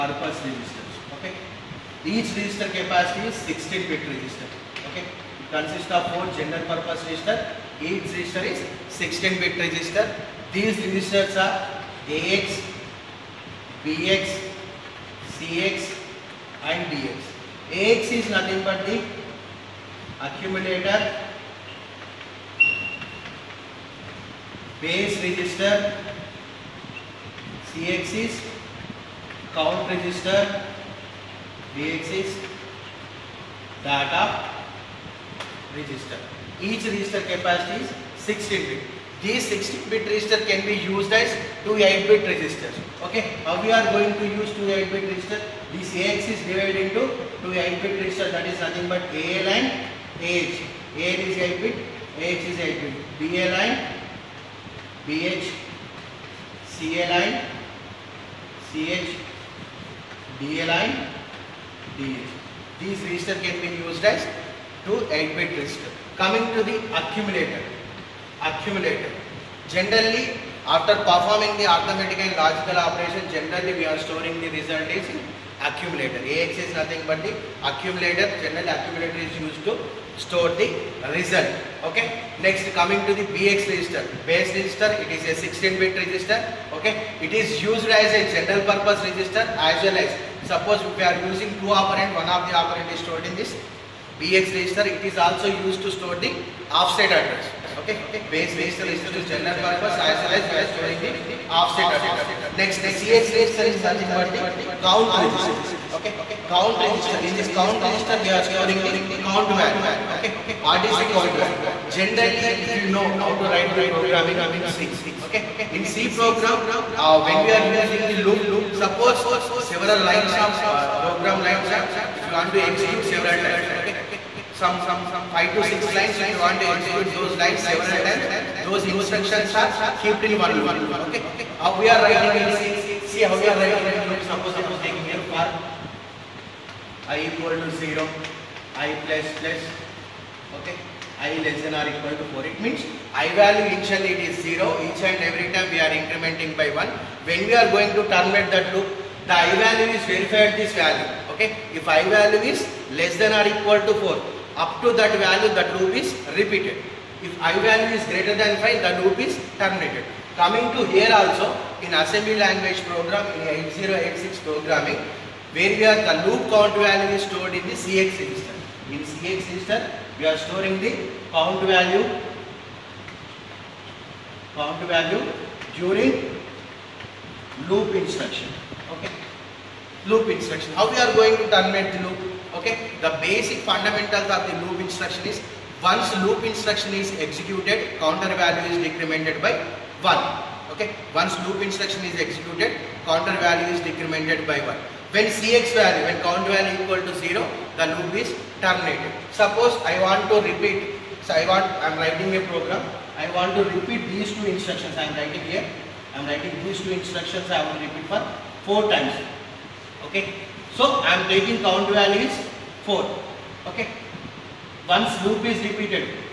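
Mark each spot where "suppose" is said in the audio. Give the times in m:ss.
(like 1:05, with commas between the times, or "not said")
1:30, 1:58, 2:14, 3:19.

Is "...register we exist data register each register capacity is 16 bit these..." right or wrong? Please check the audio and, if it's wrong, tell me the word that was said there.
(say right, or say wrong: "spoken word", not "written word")
right.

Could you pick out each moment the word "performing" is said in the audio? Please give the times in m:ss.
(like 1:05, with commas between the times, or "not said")
1:10.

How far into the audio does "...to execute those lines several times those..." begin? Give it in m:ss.
2:06.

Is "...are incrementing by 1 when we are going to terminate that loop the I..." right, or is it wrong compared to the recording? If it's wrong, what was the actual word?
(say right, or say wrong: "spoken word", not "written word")
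right.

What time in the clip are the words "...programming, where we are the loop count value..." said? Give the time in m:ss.
2:44.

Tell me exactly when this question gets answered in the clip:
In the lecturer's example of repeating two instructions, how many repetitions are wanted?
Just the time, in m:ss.
3:28.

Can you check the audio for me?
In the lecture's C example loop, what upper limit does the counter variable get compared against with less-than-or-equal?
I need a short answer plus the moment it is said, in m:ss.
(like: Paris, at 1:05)
4, at 2:21.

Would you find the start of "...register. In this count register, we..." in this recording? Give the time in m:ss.
1:46.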